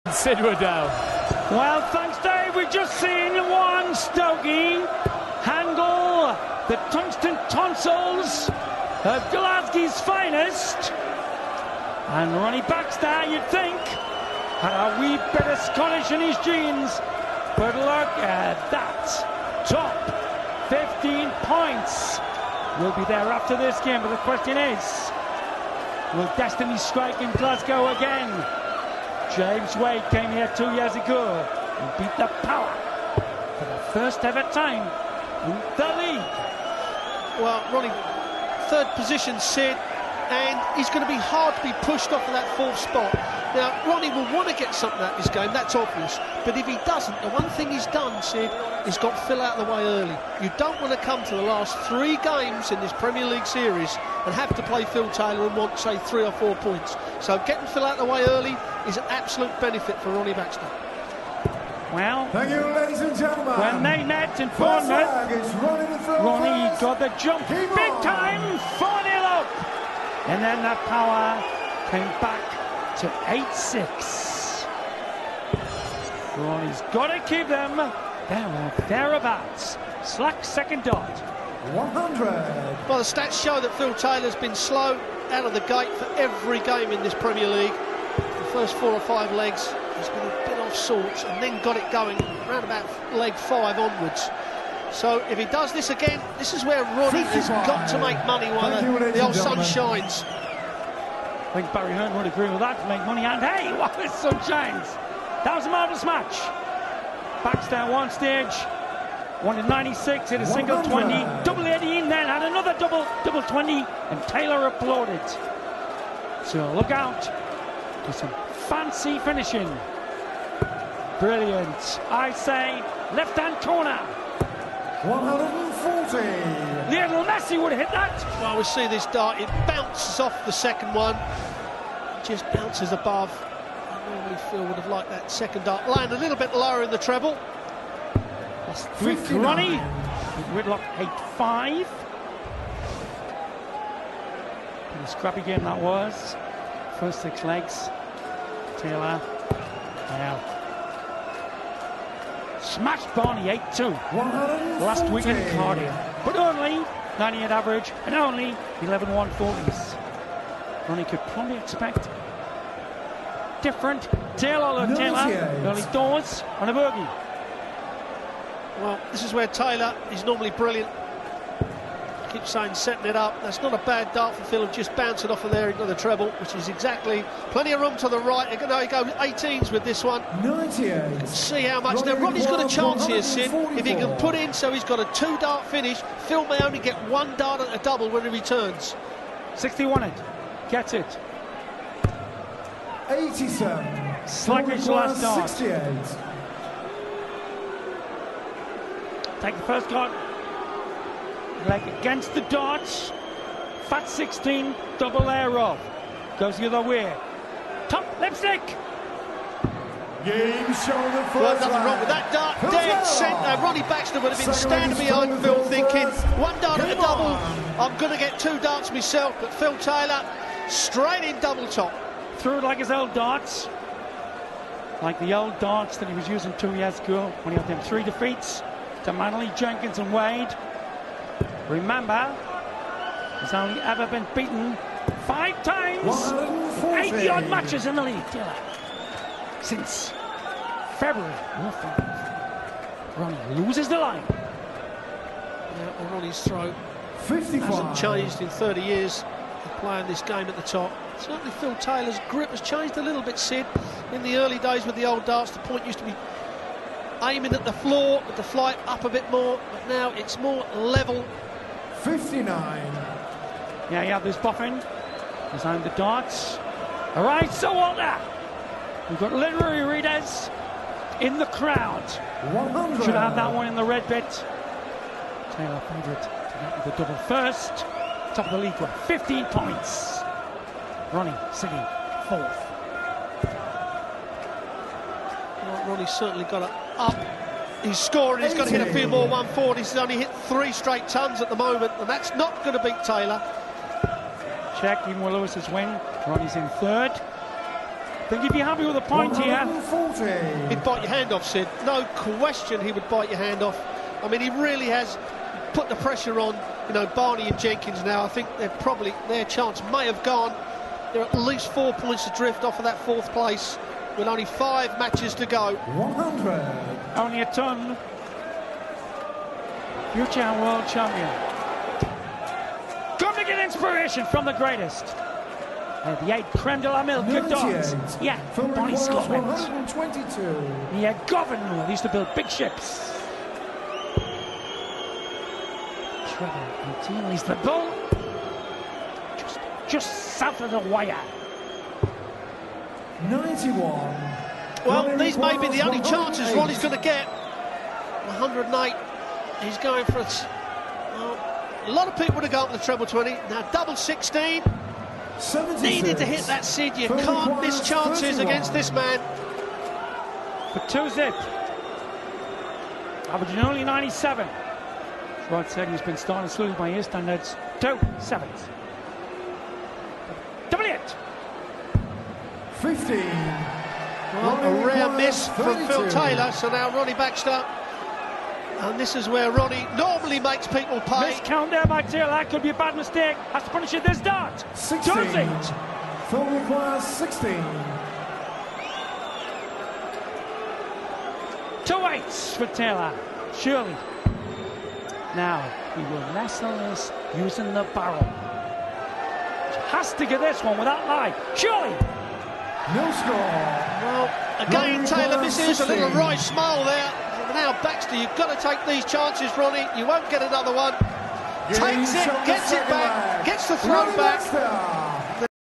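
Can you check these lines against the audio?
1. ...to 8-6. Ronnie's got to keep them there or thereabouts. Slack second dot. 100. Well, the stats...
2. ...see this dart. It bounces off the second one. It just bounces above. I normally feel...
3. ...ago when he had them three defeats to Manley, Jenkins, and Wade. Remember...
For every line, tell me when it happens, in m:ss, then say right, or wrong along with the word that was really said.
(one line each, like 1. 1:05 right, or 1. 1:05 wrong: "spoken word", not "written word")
1. 1:12 right
2. 2:08 right
3. 3:46 right.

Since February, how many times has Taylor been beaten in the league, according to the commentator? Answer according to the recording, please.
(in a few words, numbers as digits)
5.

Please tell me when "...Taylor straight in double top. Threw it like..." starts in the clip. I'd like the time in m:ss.
3:39.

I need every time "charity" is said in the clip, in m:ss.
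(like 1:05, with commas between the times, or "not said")
not said.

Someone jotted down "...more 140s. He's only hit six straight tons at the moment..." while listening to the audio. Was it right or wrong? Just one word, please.
wrong.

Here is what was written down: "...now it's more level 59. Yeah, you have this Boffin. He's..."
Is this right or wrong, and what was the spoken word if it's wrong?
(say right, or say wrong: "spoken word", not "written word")
right.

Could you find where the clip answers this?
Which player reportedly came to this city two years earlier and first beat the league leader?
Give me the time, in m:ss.
0:29.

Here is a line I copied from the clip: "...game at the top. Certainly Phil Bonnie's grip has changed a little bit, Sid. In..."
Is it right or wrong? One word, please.
wrong.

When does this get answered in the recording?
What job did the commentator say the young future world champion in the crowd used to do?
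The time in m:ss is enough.
5:32.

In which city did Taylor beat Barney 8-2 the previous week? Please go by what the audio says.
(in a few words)
Cardiff.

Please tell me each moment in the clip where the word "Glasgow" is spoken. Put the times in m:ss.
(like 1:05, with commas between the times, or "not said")
0:09, 0:27.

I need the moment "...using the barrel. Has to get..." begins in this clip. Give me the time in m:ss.
6:37.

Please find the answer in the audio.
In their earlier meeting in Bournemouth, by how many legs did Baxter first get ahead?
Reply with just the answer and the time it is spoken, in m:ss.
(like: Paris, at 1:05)
4, at 1:08.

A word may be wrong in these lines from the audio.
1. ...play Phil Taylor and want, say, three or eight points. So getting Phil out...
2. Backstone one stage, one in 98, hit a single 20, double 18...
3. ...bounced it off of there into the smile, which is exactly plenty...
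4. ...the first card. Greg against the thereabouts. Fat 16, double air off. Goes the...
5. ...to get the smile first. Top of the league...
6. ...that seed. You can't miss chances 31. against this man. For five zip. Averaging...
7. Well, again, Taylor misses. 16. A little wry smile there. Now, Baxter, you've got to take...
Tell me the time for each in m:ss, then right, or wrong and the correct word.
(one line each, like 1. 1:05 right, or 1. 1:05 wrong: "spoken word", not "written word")
1. 0:54 wrong: "four", not "eight"
2. 1:47 wrong: "96", not "98"
3. 2:54 wrong: "treble", not "smile"
4. 3:19 wrong: "darts", not "thereabouts"
5. 4:36 wrong: "double", not "smile"
6. 5:56 wrong: "two", not "five"
7. 6:44 right.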